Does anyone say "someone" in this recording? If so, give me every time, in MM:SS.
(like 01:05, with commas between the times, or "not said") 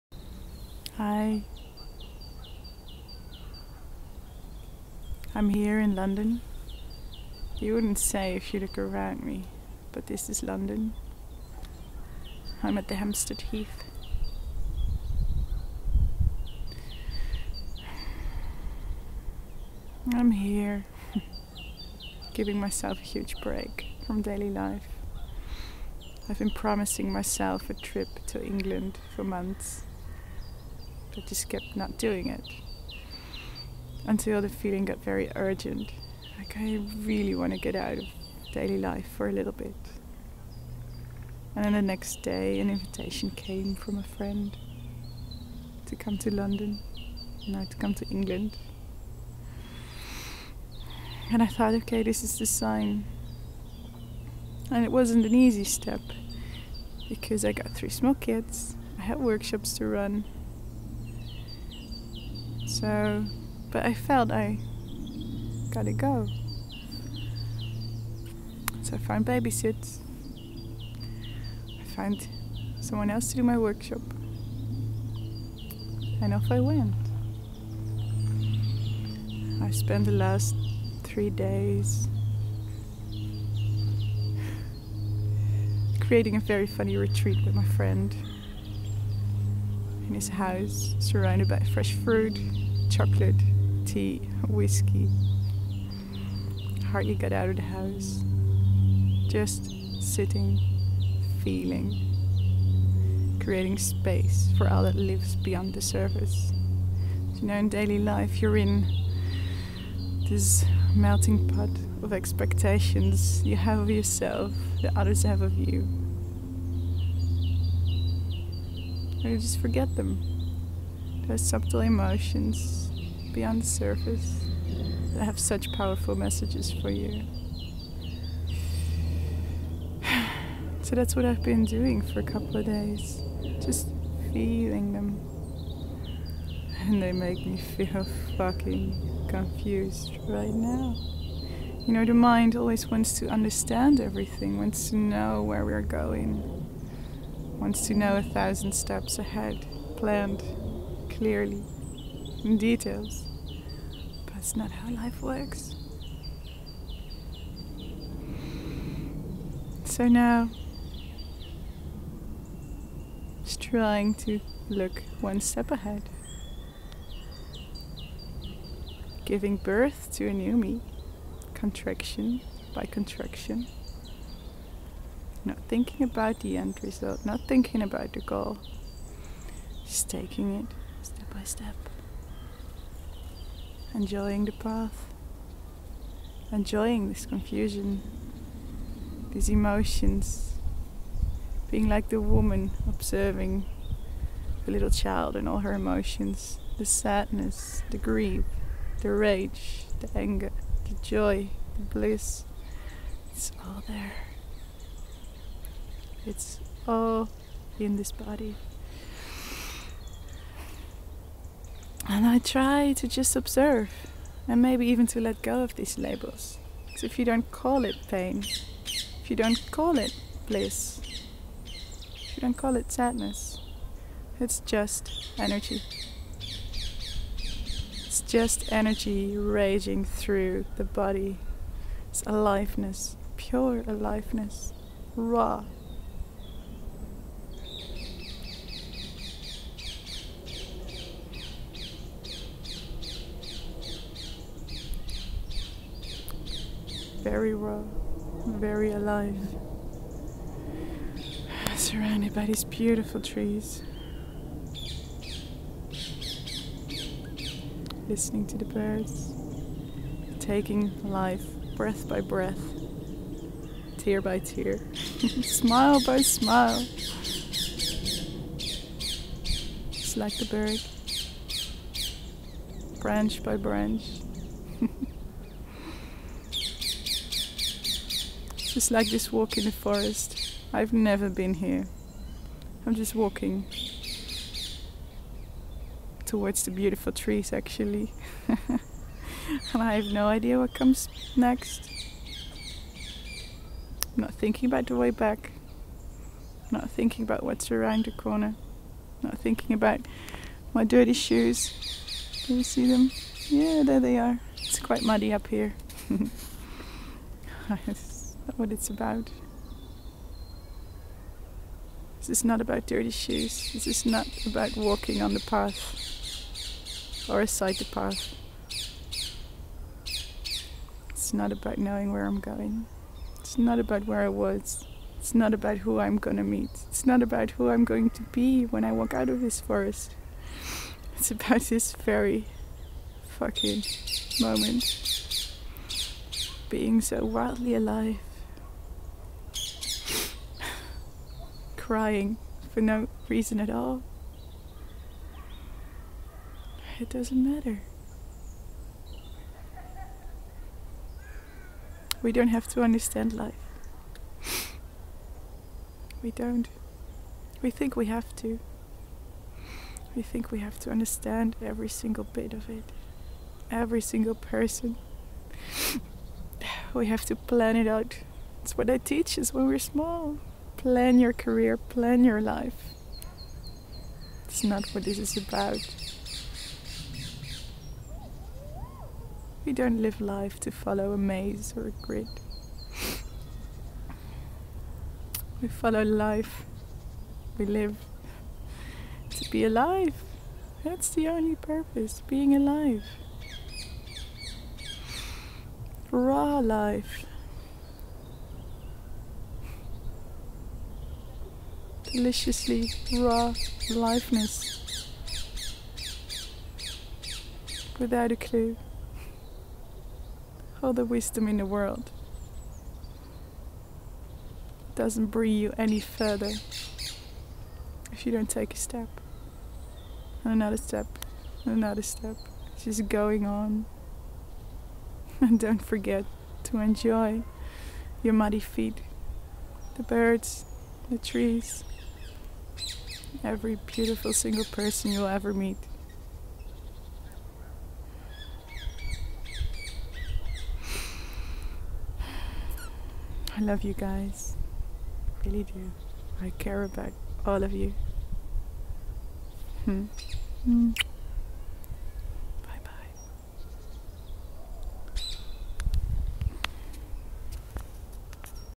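01:12.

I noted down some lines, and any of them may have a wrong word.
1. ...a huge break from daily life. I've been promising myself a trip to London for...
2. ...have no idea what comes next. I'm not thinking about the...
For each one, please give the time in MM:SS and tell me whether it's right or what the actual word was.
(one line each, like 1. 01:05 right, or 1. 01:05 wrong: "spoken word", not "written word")
1. 00:22 wrong: "England", not "London"
2. 04:49 right.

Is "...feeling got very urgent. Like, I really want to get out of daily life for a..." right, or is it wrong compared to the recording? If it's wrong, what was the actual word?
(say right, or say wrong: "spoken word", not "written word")
right.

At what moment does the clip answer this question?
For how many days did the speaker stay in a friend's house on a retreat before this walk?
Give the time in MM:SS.
01:21.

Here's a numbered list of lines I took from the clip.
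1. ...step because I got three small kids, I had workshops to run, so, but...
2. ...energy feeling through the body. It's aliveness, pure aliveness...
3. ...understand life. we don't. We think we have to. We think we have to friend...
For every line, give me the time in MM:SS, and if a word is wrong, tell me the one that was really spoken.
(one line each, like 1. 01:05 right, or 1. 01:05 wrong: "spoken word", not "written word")
1. 00:55 right
2. 03:48 wrong: "raging", not "feeling"
3. 05:52 wrong: "understand", not "friend".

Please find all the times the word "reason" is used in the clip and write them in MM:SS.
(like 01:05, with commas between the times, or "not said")
05:43.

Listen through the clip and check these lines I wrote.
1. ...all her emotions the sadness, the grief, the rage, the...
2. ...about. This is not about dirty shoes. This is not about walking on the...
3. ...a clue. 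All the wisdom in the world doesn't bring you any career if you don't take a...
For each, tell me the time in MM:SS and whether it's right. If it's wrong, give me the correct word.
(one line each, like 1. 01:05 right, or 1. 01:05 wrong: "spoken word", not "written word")
1. 03:15 right
2. 05:08 right
3. 06:48 wrong: "further", not "career".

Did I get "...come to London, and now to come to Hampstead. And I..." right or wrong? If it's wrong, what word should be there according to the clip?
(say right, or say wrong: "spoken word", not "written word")
wrong: "England", not "Hampstead".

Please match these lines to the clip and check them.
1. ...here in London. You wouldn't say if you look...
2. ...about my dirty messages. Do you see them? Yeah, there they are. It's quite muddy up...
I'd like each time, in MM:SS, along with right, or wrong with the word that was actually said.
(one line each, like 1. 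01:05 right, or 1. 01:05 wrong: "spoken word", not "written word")
1. 00:05 right
2. 04:59 wrong: "shoes", not "messages".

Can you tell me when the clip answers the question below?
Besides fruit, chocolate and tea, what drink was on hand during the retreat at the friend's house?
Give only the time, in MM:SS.
01:34.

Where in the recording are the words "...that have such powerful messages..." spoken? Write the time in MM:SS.
02:05.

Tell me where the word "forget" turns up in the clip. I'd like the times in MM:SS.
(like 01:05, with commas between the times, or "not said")
01:59, 07:05.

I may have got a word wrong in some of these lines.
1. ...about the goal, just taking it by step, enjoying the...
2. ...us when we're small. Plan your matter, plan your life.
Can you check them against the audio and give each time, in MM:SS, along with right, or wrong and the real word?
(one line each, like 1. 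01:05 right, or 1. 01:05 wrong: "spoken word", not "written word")
1. 02:57 right
2. 06:09 wrong: "career", not "matter".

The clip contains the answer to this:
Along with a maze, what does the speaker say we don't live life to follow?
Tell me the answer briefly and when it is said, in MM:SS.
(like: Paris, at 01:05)
a grid, at 06:21.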